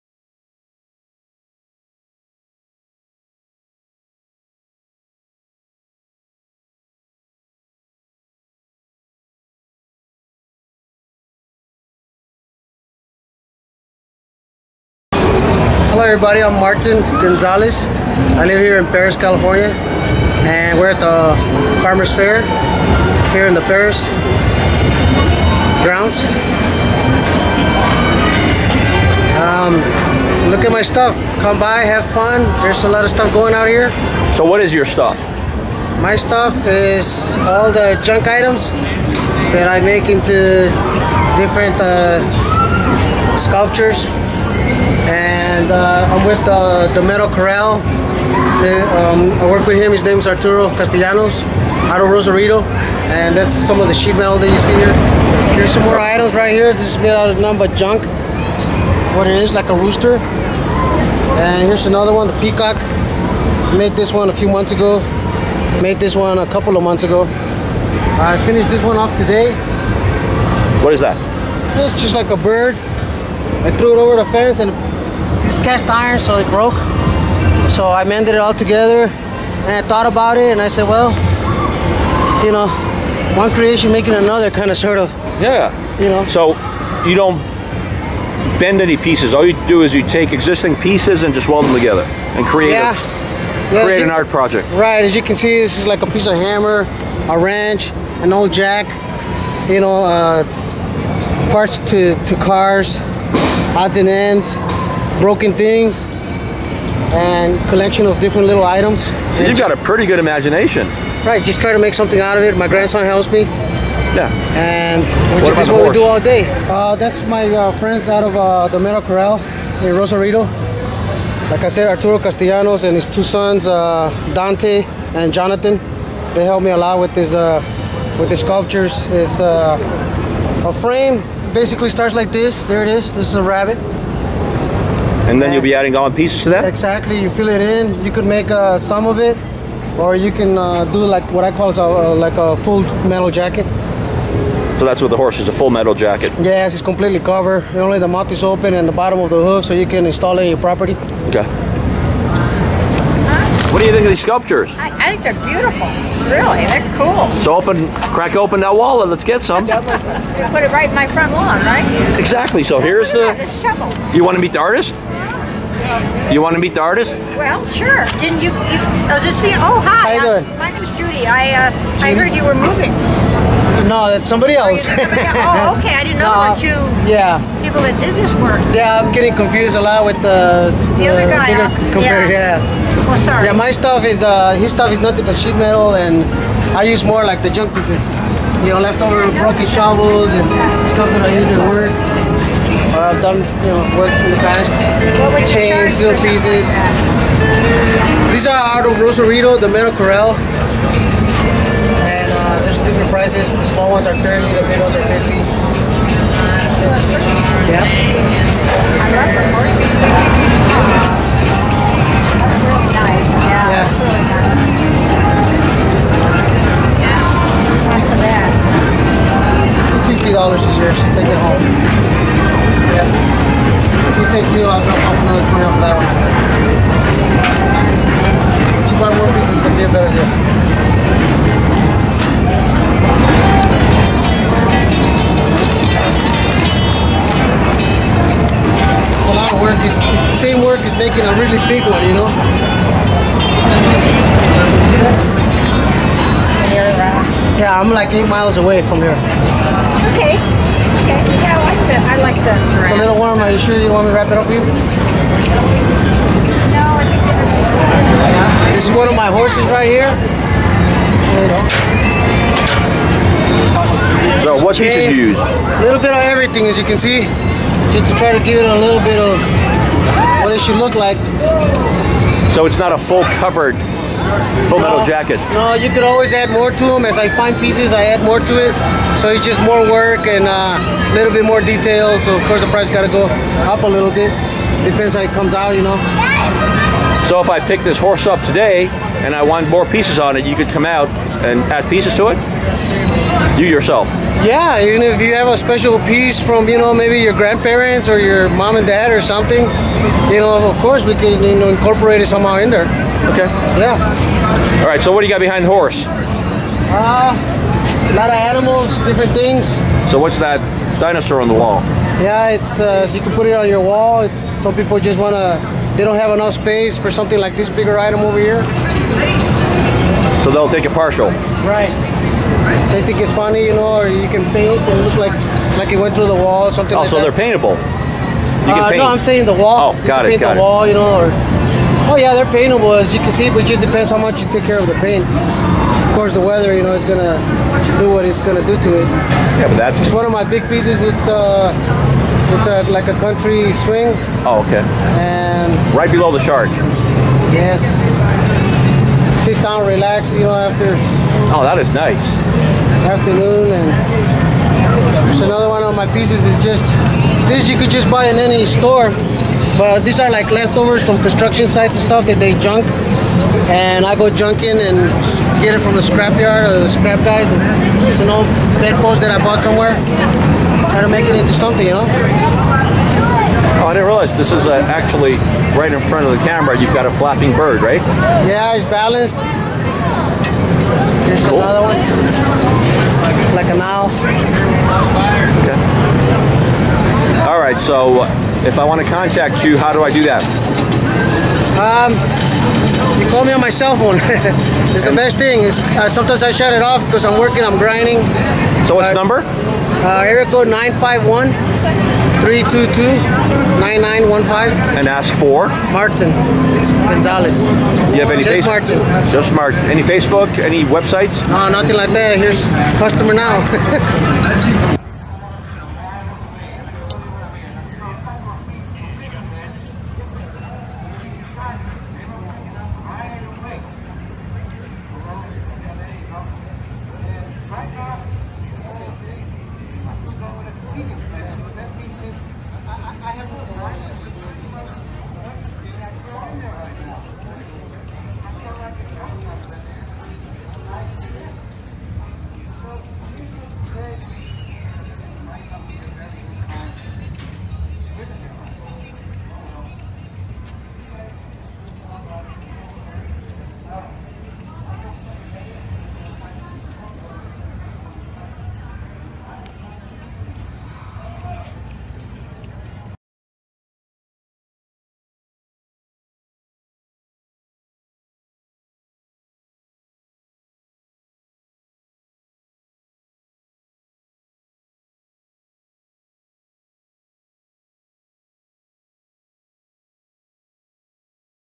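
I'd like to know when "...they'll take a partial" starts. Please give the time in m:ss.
5:20.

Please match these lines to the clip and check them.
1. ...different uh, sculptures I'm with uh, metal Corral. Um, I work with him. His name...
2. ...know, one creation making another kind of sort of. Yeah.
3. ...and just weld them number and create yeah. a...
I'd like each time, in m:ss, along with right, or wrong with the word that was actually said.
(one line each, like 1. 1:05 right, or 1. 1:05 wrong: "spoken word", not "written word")
1. 0:41 right
2. 1:22 right
3. 1:31 wrong: "together", not "number".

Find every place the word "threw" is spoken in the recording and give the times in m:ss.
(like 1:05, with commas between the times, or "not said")
1:13.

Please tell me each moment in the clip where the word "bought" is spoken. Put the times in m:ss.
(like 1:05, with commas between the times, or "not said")
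6:09.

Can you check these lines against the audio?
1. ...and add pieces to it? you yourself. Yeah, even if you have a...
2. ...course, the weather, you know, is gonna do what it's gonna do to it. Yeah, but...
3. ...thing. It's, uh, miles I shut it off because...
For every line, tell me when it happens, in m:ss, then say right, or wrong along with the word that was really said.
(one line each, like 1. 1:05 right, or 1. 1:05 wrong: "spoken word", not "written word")
1. 4:51 right
2. 5:36 right
3. 6:35 wrong: "sometimes", not "miles".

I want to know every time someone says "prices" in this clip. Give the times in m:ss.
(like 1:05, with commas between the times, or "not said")
3:23, 4:42.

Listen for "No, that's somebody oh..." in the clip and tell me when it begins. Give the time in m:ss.
2:53.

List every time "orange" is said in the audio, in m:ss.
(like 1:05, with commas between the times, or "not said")
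not said.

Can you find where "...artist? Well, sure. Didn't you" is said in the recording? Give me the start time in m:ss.
2:46.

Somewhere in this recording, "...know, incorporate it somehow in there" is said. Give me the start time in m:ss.
5:01.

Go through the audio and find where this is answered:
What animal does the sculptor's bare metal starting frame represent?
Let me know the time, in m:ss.
2:13.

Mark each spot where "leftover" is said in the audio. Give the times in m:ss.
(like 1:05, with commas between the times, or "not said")
3:08, 6:00.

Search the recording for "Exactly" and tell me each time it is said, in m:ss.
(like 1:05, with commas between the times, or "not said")
2:16, 2:42.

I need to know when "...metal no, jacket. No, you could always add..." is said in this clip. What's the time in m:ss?
4:34.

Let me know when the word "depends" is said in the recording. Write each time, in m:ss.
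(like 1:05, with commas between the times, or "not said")
4:44, 5:33.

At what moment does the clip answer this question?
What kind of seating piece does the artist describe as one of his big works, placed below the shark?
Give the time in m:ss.
5:42.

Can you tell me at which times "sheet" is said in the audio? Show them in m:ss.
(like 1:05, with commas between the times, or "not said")
0:53, 3:05.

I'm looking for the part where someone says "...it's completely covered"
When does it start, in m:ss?
2:26.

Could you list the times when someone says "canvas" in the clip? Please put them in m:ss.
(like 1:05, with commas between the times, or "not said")
not said.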